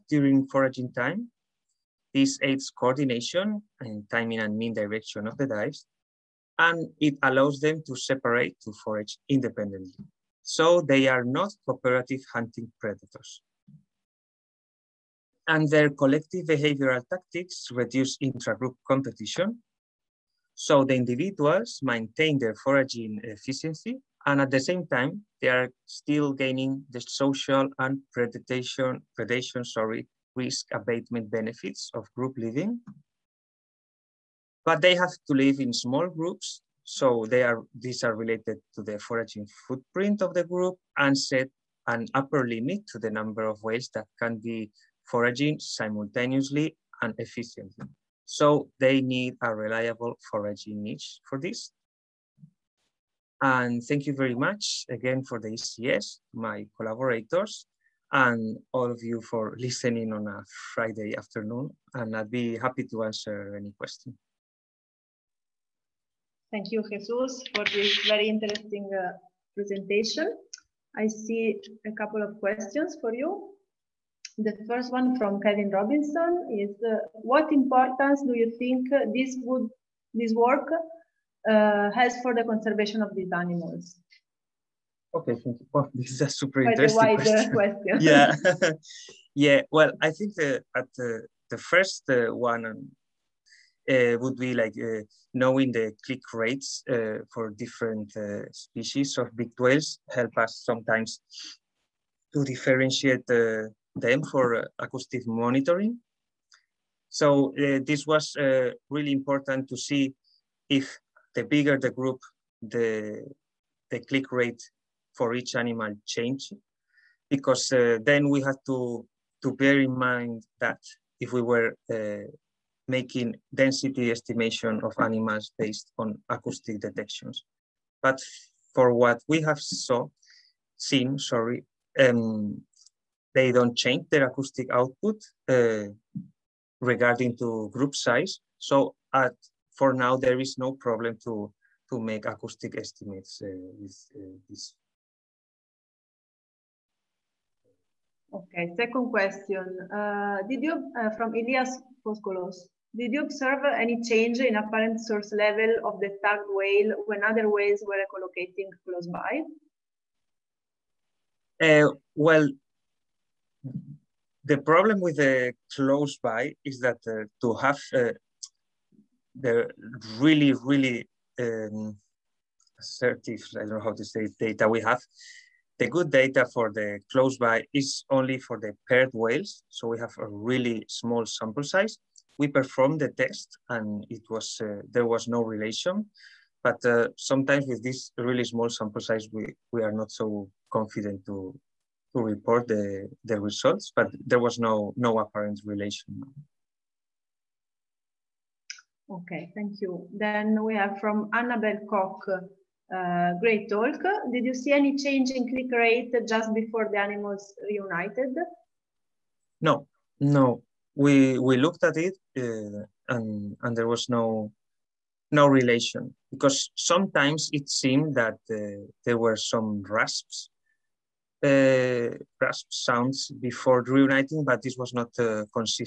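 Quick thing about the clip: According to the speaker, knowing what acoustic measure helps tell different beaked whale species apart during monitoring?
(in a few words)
click rates.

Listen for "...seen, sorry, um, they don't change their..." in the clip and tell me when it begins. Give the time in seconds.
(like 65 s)
130 s.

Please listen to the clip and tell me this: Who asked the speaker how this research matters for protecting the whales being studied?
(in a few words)
Kevin Robinson.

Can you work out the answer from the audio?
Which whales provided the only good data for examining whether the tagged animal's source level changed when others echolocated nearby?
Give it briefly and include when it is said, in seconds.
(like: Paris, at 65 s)
paired whales, at 178 s.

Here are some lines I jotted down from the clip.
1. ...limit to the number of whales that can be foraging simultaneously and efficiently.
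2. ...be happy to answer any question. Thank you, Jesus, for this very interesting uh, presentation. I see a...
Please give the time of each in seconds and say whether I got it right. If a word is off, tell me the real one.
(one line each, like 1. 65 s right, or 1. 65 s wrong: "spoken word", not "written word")
1. 42 s right
2. 62 s right.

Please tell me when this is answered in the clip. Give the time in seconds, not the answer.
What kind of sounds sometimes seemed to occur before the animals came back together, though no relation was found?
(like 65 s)
222 s.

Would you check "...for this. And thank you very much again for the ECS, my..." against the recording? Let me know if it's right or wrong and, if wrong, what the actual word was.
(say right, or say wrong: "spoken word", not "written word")
right.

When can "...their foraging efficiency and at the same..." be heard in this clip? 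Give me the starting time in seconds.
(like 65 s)
22 s.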